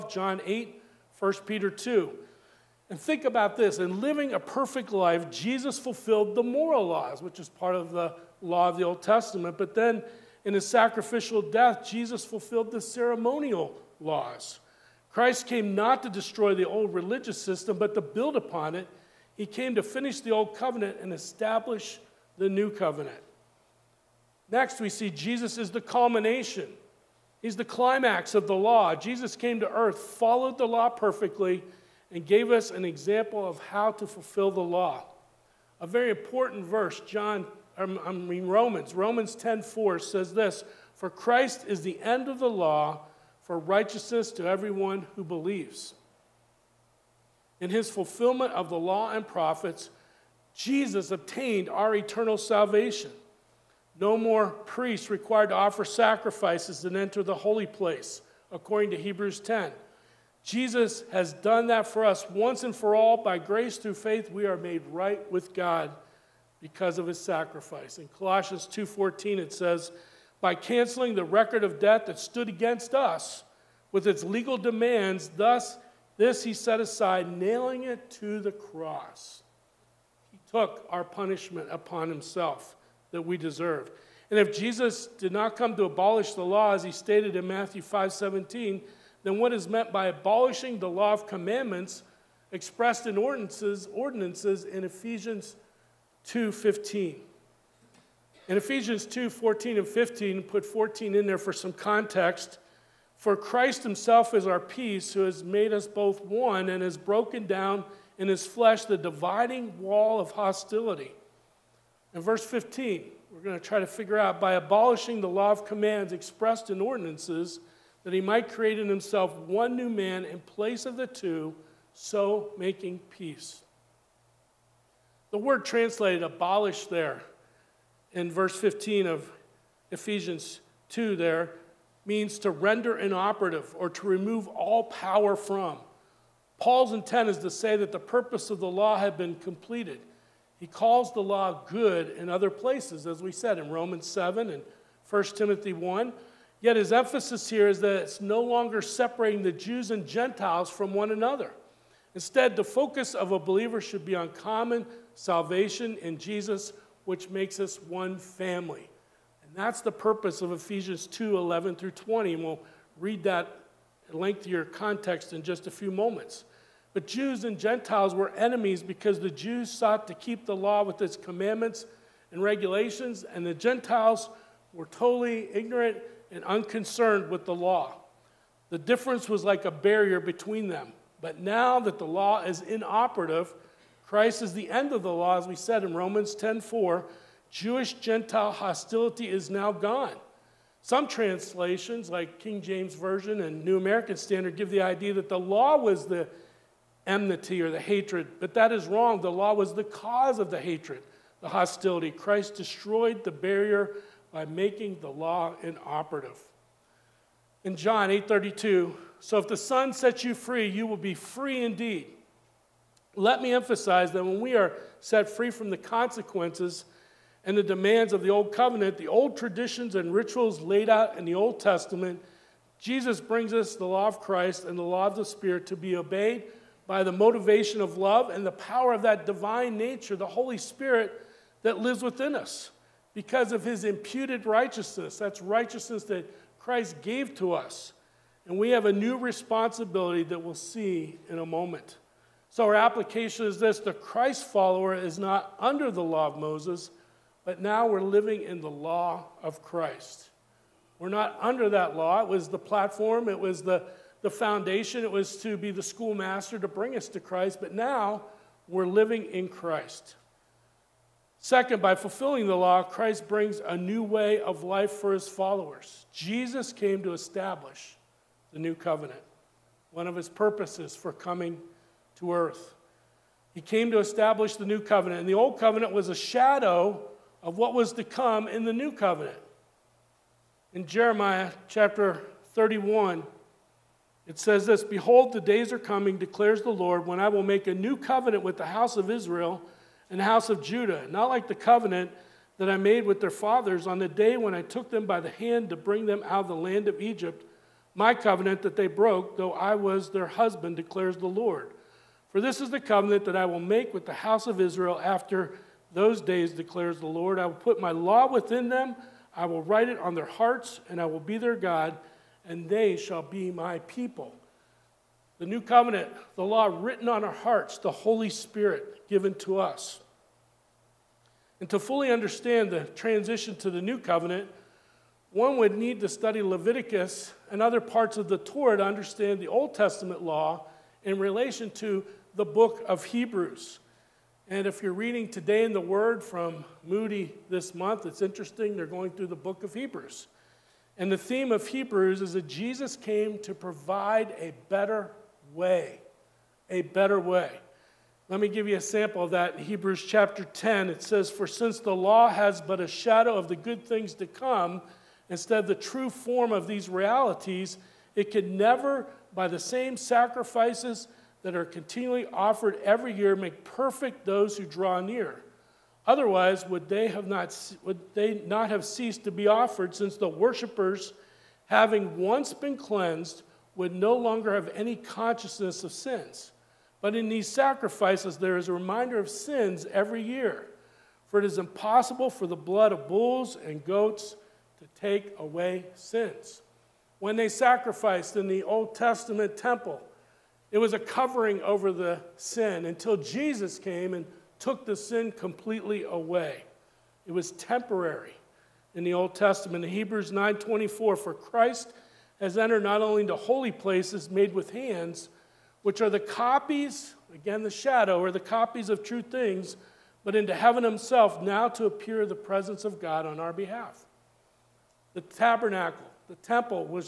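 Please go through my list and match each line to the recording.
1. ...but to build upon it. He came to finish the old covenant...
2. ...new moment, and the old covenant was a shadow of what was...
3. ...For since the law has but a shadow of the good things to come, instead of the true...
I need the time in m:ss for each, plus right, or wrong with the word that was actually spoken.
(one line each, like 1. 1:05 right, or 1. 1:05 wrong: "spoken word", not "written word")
1. 0:17 right
2. 4:34 wrong: "covenant", not "moment"
3. 5:51 right.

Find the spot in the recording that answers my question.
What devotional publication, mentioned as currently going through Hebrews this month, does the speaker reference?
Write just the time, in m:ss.
5:35.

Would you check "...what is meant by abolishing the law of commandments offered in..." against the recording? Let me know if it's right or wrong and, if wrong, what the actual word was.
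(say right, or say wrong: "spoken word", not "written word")
wrong: "expressed", not "offered".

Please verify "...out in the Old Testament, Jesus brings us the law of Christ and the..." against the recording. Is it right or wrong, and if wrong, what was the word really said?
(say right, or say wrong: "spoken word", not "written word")
right.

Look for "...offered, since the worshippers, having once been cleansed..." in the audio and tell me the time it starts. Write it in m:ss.
6:09.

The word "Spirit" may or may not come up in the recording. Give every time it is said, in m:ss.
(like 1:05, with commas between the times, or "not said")
3:45, 3:50, 5:18.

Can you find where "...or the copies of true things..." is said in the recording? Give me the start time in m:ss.
6:48.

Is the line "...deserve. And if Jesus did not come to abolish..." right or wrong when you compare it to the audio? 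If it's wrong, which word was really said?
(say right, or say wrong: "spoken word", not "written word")
right.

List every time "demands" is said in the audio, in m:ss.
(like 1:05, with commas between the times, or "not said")
1:14, 3:37.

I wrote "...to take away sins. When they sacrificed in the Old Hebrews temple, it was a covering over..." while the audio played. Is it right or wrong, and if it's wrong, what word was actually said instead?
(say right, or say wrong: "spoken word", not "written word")
wrong: "Testament", not "Hebrews".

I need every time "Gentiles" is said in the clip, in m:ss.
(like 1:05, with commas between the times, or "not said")
2:30, 2:47, 2:53, 3:07.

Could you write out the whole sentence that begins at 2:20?
He calls the law good in other places, as we said in Romans 7 and 1 Timothy 1.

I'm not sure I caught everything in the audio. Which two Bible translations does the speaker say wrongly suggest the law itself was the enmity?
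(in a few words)
King James Version and New American Standard.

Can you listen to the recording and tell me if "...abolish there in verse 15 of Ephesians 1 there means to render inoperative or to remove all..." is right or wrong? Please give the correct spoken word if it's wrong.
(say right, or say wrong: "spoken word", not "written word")
wrong: "2", not "1".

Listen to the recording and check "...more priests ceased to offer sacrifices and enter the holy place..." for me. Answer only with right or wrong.
wrong.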